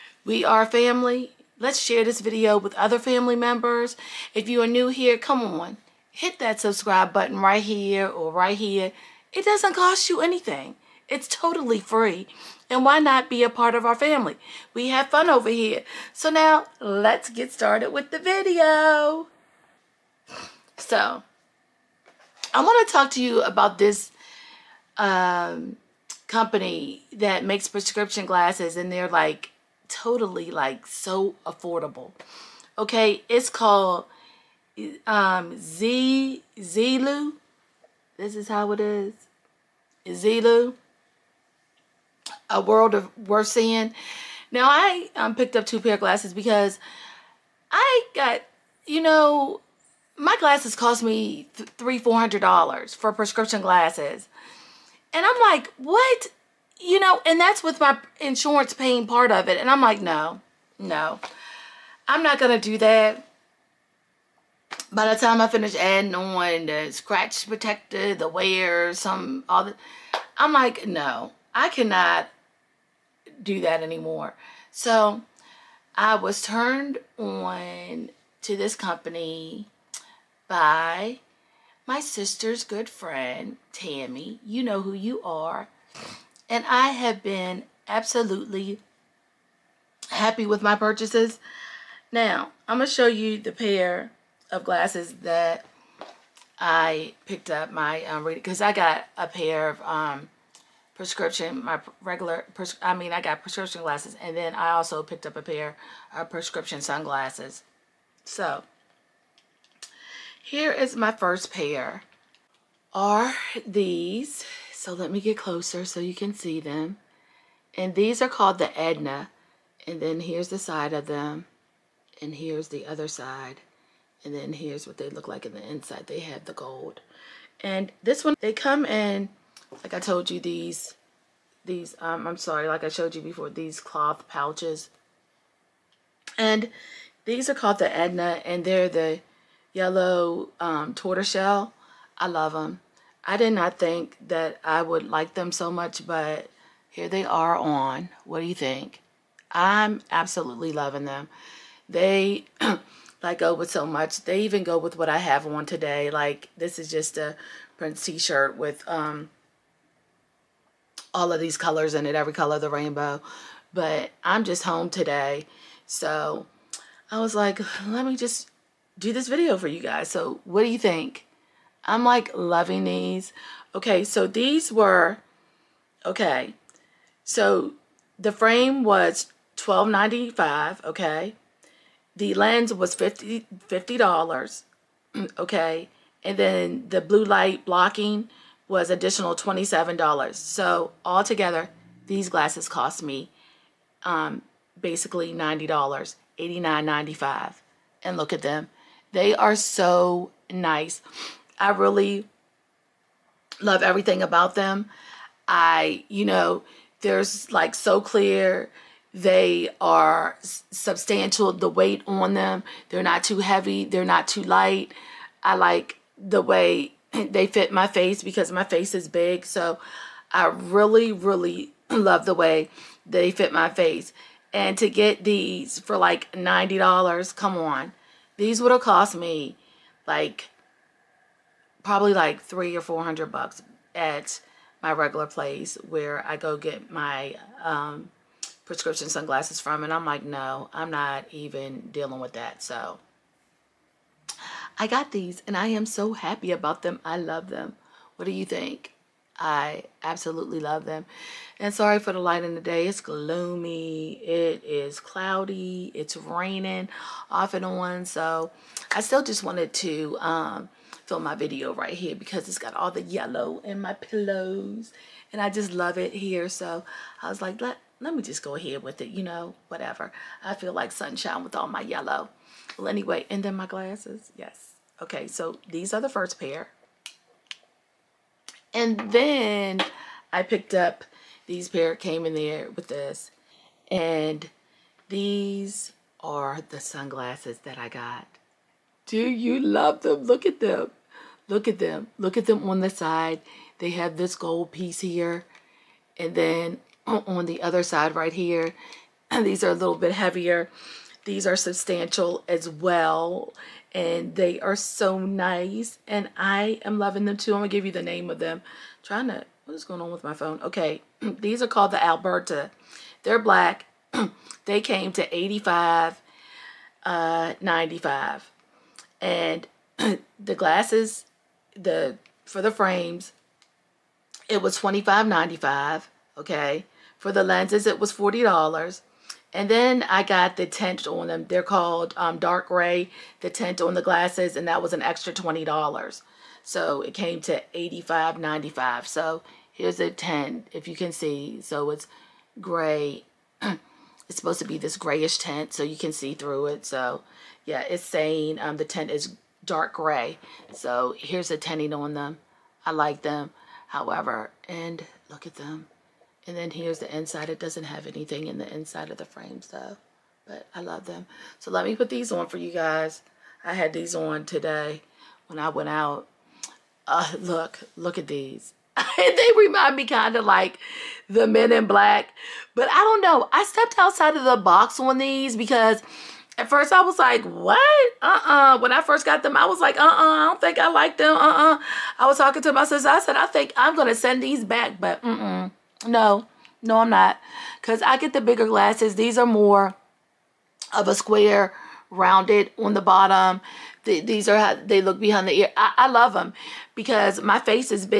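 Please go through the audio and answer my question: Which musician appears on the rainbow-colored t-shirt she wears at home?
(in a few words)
Prince.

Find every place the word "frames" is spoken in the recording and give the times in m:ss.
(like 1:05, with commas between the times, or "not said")
2:58, 5:22, 5:59.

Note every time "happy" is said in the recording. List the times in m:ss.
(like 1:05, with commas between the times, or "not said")
1:30, 4:06.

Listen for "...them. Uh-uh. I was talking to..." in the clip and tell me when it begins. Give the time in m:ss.
6:21.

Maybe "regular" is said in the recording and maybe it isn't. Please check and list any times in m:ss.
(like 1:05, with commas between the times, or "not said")
1:42, 3:54.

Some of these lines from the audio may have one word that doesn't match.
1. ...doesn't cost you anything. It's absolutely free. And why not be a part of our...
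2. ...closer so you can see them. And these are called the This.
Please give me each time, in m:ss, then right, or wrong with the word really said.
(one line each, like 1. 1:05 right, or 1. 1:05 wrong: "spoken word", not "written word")
1. 0:09 wrong: "totally", not "absolutely"
2. 1:55 wrong: "Edna", not "This".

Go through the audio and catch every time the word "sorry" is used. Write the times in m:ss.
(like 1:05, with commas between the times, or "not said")
2:12, 4:11.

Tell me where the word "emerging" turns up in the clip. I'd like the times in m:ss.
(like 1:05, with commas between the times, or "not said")
not said.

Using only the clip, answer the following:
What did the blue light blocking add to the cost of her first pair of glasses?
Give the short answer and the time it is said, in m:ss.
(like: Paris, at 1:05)
$27, at 3:09.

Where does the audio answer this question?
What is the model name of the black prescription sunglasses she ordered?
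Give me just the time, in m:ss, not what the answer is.
5:12.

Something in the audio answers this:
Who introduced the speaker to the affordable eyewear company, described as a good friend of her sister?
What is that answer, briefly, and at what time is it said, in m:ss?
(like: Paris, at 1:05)
Tammy, at 1:23.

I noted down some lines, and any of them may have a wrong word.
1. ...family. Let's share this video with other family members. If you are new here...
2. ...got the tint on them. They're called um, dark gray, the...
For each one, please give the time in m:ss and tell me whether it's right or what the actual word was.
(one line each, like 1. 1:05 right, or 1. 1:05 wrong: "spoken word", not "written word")
1. 0:00 right
2. 5:30 right.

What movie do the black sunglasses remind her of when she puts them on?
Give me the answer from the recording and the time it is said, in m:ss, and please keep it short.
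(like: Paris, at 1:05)
Men in Black, at 6:11.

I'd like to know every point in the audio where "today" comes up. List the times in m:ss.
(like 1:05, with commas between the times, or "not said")
2:35, 2:44, 6:04.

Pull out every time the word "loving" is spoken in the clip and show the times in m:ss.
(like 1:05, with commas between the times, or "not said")
2:30, 2:52, 5:06.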